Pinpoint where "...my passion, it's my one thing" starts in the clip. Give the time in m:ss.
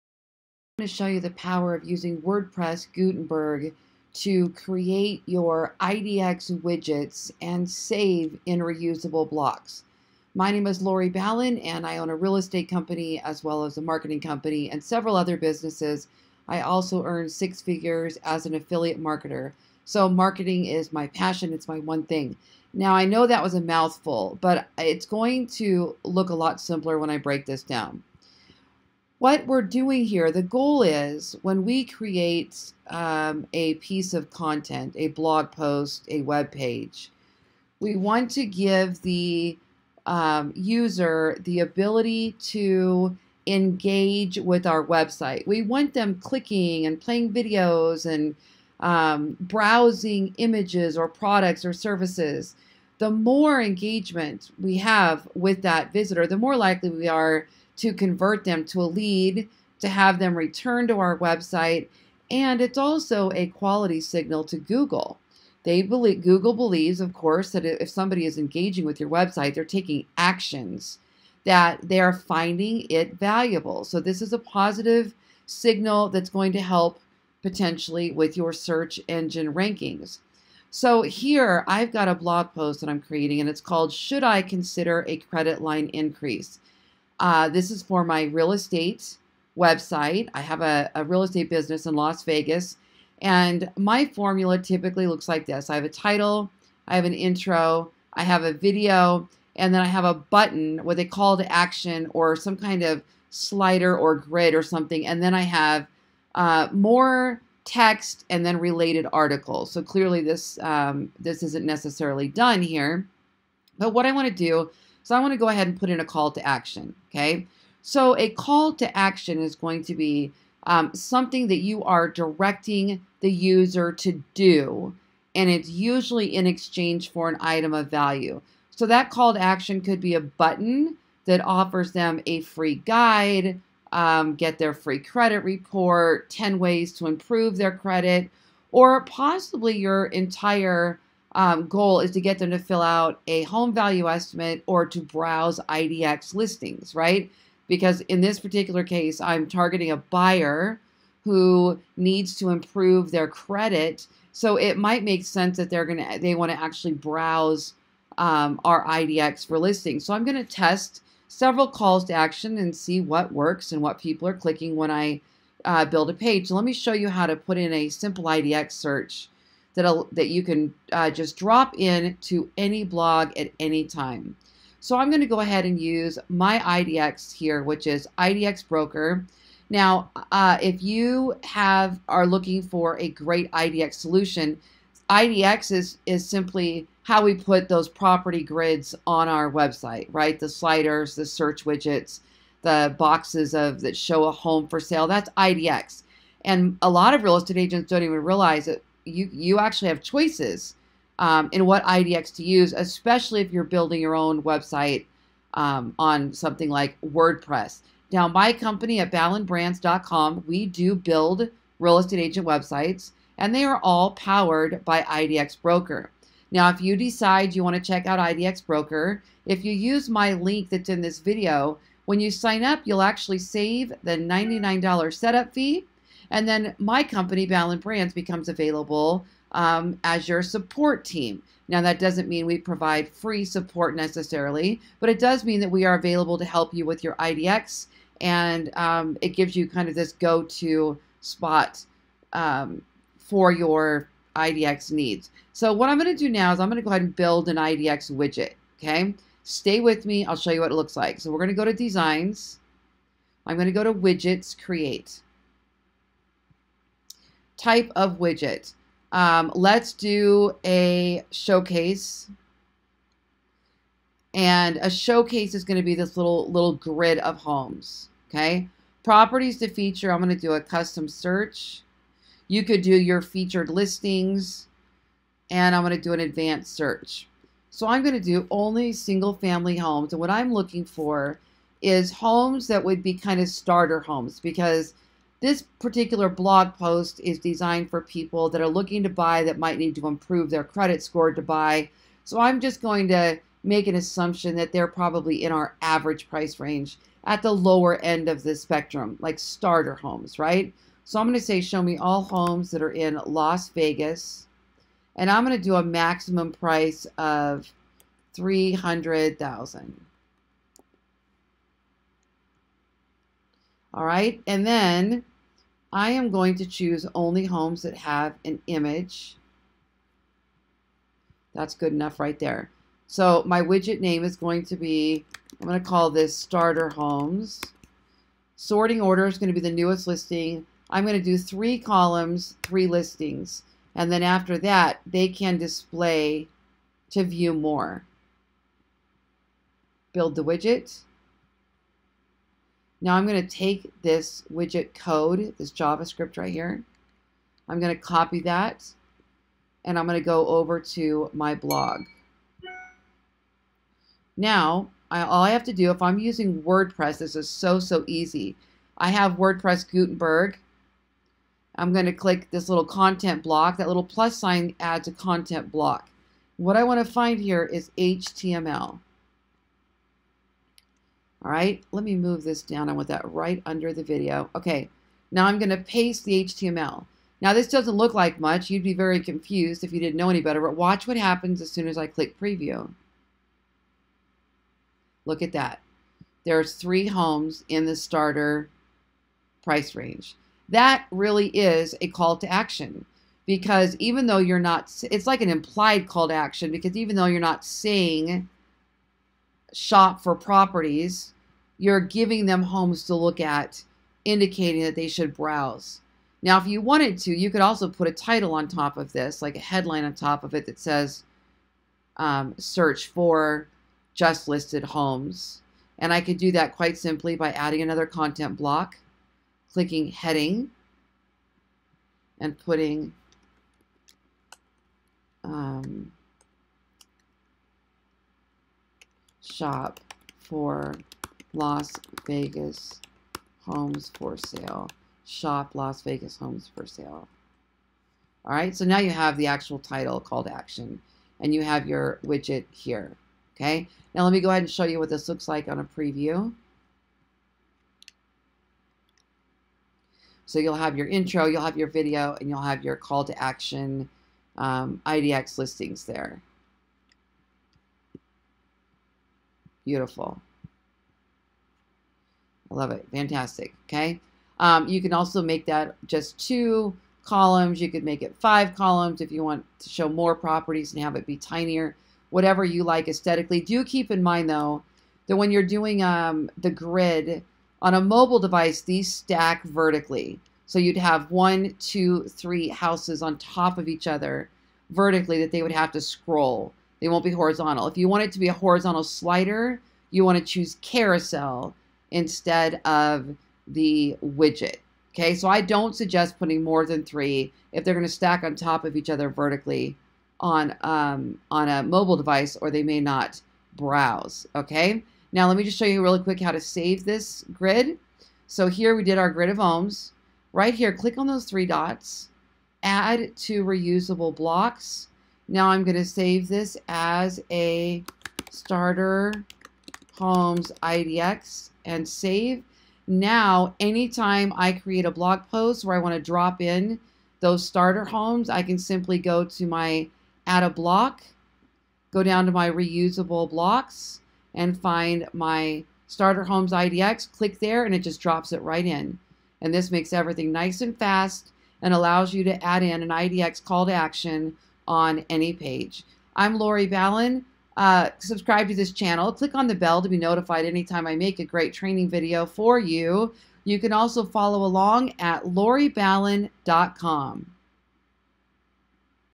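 0:20.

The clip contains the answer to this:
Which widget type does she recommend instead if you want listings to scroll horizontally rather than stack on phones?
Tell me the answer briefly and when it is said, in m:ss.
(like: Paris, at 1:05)
carousel, at 8:10.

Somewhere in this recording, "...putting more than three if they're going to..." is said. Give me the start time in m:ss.
8:16.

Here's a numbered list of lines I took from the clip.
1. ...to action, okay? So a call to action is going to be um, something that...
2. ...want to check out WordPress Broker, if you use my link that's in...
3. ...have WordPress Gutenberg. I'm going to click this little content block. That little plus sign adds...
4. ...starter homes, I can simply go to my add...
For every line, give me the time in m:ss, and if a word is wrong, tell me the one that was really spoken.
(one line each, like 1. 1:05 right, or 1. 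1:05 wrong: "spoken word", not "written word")
1. 1:56 right
2. 3:37 wrong: "IDX", not "WordPress"
3. 5:59 right
4. 8:47 right.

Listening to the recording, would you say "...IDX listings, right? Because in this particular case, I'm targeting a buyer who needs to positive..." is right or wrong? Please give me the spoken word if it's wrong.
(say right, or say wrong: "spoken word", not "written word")
wrong: "improve", not "positive".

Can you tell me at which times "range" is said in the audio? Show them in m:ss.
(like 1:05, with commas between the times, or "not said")
4:56, 6:29.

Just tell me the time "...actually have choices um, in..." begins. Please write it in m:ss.
3:19.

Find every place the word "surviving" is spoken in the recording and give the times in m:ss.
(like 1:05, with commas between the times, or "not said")
not said.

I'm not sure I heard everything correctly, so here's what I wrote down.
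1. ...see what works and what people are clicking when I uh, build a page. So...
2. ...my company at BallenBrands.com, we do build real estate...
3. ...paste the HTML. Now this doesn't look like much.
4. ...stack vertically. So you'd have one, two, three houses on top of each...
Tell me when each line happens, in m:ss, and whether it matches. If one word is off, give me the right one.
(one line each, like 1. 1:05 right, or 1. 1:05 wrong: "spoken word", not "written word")
1. 2:42 right
2. 3:28 right
3. 6:15 right
4. 7:59 right.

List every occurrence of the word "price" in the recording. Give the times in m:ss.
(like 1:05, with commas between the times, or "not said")
4:56, 5:06, 6:29.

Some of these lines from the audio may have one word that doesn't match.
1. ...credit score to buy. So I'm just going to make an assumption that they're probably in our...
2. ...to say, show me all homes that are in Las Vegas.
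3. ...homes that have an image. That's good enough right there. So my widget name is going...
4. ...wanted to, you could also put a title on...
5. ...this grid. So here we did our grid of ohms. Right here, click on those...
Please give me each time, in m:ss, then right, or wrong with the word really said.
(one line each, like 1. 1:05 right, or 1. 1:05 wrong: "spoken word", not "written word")
1. 4:50 right
2. 5:01 right
3. 5:17 right
4. 6:46 right
5. 8:27 right.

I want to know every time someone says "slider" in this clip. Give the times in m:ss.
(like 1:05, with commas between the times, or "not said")
1:43, 3:10, 8:09.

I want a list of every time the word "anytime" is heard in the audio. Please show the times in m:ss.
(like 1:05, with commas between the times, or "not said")
8:43, 9:10.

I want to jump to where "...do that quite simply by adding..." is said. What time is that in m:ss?
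6:56.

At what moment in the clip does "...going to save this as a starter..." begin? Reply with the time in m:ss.
8:35.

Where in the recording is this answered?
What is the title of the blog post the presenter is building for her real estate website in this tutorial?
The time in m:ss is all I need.
1:23.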